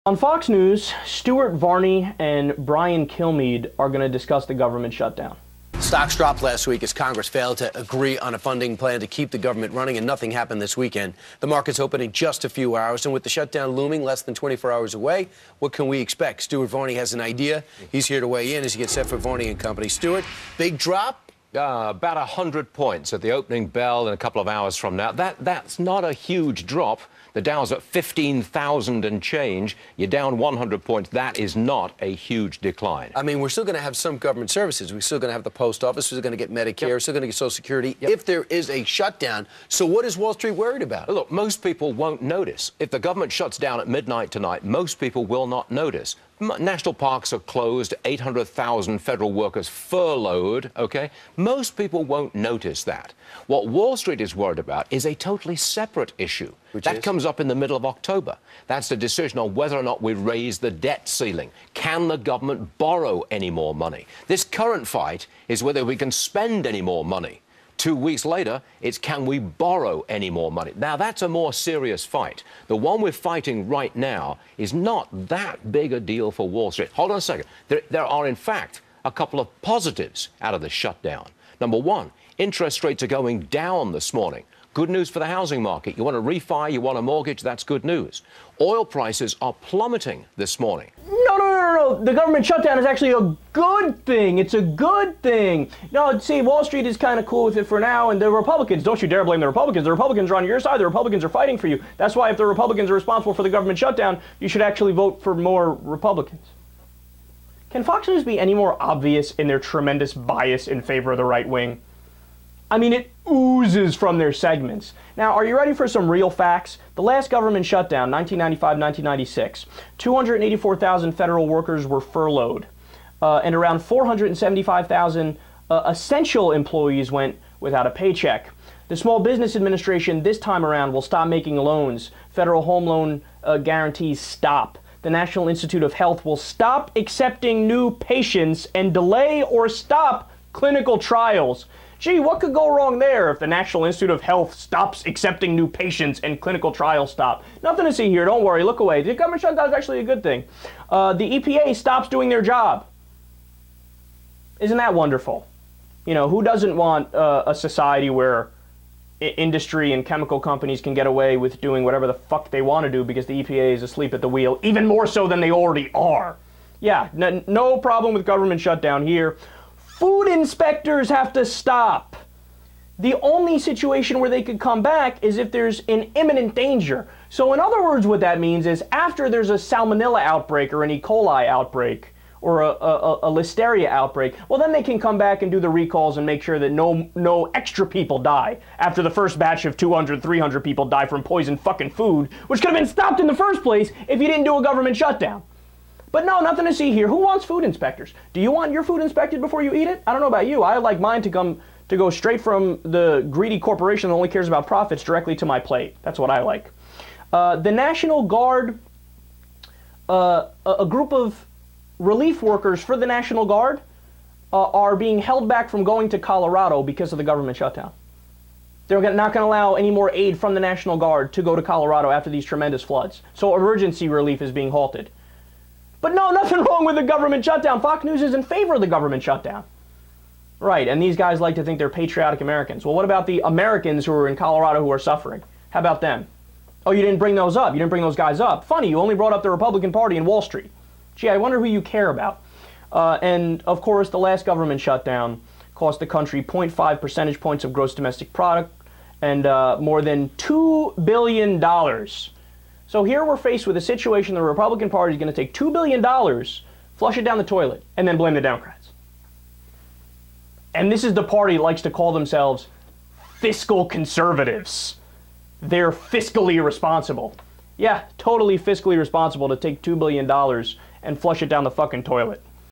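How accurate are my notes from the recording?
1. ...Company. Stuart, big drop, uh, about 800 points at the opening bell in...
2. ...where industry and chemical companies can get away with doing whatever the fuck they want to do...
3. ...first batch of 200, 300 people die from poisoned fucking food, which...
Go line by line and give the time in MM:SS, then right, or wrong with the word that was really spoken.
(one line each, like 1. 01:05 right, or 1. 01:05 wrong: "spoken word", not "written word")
1. 00:19 wrong: "100", not "800"
2. 02:38 right
3. 03:09 right.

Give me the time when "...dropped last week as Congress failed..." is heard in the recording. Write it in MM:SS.
00:06.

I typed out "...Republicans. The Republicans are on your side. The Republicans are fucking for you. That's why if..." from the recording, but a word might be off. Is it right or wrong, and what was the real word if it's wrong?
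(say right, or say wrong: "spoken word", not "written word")
wrong: "fighting", not "fucking".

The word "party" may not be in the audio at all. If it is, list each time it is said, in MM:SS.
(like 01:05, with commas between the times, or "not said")
03:59, 04:14, 04:21.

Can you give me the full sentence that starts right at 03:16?
But no, nothing to see here.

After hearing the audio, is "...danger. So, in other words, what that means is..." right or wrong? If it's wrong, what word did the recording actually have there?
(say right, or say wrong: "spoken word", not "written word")
right.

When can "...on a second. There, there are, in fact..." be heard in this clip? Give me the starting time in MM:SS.
01:17.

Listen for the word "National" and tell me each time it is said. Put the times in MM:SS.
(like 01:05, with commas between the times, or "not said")
00:46, 02:15, 02:23, 03:27, 03:33, 03:40.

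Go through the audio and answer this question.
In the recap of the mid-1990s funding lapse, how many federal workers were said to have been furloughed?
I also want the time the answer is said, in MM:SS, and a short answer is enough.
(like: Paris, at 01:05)
284,000, at 01:59.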